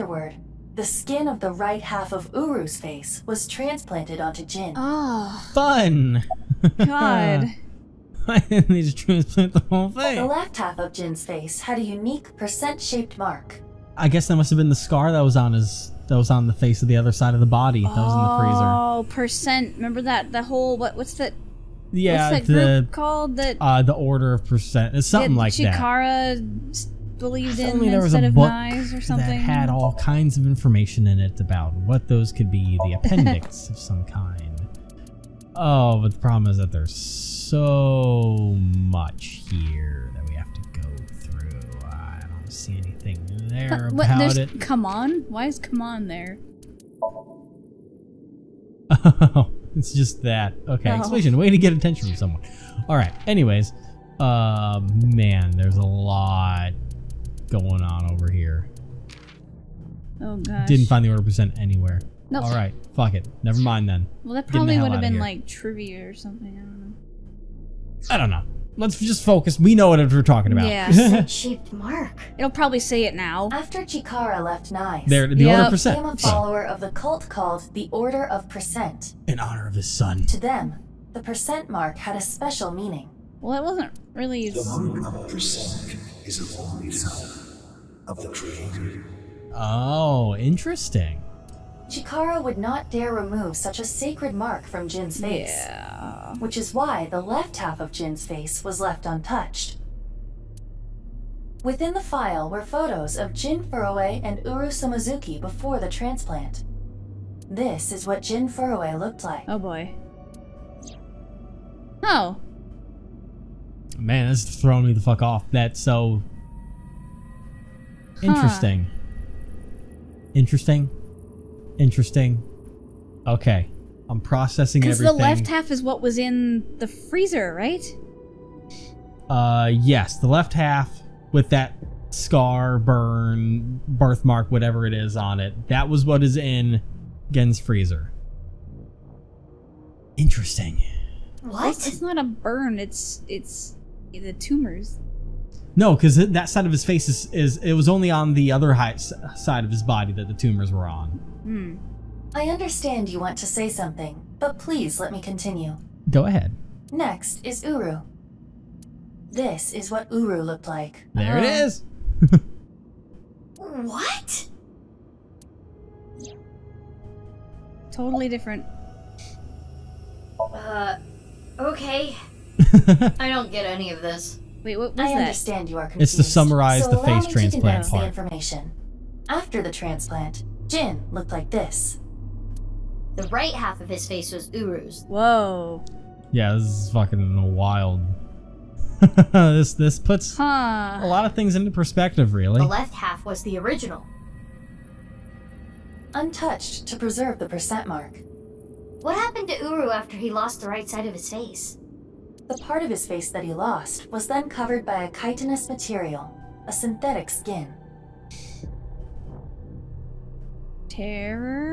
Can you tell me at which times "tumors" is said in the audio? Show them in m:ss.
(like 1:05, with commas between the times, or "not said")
2:24, 2:30.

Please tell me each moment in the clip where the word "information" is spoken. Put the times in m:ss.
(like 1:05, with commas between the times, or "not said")
0:30, 2:58.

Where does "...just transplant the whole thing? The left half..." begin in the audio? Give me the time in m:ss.
0:08.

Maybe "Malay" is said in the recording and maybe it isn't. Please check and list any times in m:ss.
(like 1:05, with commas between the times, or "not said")
not said.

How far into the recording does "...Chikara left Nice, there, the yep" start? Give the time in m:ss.
1:13.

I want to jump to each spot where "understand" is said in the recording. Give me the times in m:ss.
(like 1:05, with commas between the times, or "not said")
2:32, 2:55.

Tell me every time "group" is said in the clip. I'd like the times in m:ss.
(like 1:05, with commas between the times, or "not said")
0:22.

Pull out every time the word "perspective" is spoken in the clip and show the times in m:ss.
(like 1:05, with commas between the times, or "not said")
3:11.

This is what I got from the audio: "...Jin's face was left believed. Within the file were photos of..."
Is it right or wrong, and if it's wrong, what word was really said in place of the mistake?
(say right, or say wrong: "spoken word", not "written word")
wrong: "untouched", not "believed".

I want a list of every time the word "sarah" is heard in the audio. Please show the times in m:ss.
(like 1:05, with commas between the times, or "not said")
not said.